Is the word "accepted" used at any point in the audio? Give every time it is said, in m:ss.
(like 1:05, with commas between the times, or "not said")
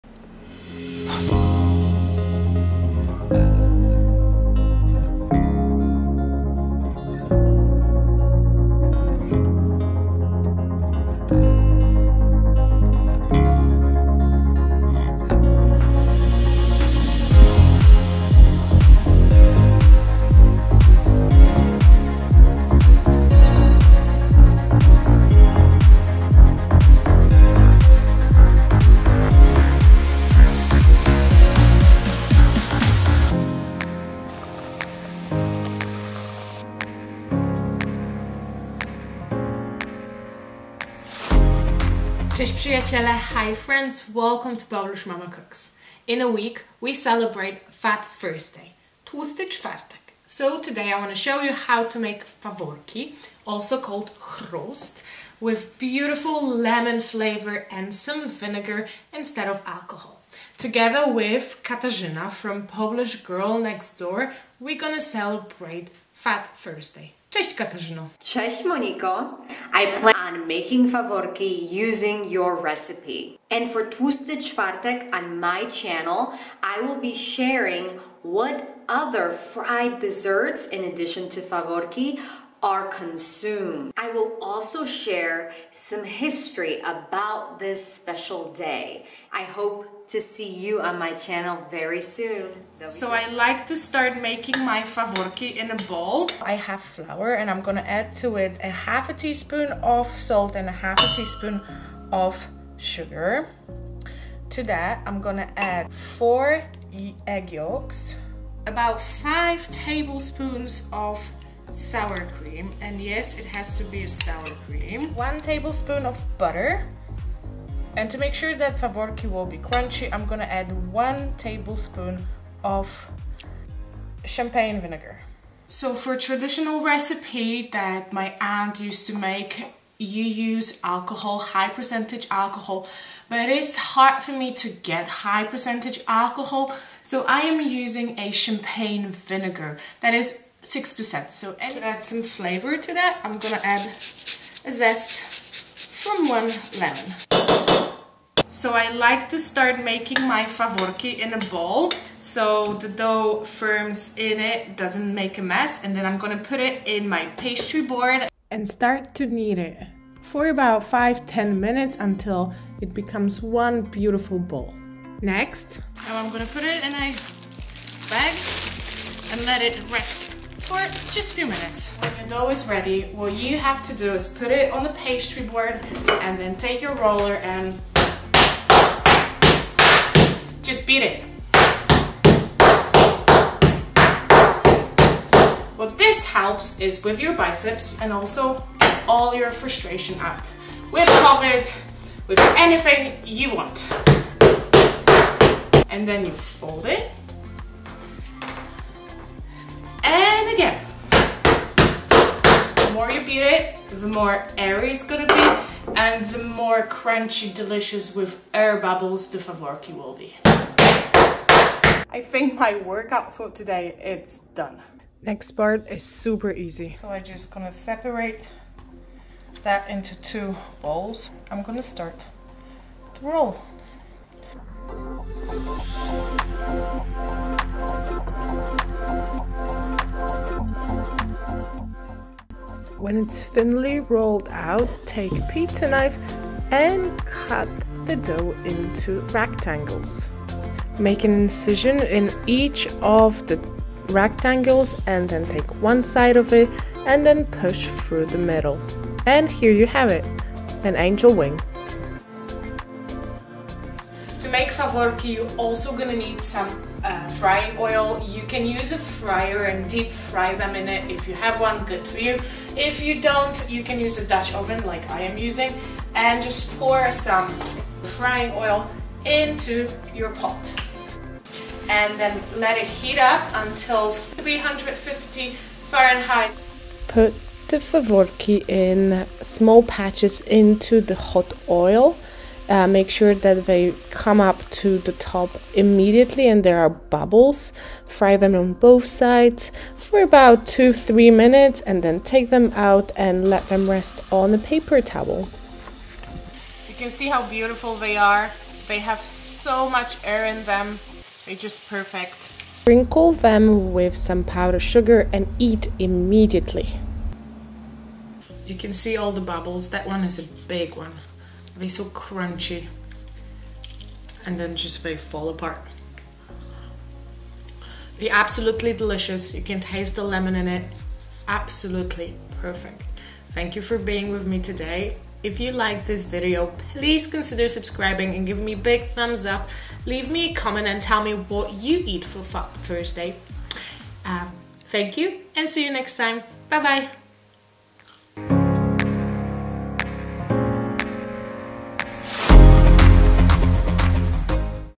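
not said.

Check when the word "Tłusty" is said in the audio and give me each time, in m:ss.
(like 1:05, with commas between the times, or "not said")
0:49, 1:13.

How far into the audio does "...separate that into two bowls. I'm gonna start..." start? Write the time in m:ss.
3:37.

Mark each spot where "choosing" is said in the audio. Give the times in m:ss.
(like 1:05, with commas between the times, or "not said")
not said.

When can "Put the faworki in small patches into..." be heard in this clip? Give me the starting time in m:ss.
4:37.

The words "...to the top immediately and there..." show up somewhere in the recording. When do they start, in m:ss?
4:44.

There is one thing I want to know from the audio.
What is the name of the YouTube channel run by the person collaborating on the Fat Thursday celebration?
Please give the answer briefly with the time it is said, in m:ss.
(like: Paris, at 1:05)
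Polish Girl Next Door, at 1:02.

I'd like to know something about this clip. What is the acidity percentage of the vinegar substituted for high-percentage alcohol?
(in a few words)
6%.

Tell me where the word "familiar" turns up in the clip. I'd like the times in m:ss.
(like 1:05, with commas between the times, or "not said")
not said.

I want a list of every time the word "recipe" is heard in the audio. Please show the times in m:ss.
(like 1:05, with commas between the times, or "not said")
1:12, 2:06.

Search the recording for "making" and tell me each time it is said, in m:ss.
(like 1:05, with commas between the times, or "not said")
1:10, 1:34, 2:29.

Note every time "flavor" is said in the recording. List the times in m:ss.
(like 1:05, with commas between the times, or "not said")
0:57, 2:22.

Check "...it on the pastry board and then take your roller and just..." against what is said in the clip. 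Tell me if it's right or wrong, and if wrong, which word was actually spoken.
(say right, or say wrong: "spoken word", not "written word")
right.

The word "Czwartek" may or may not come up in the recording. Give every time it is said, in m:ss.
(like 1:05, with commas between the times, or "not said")
0:49, 1:14.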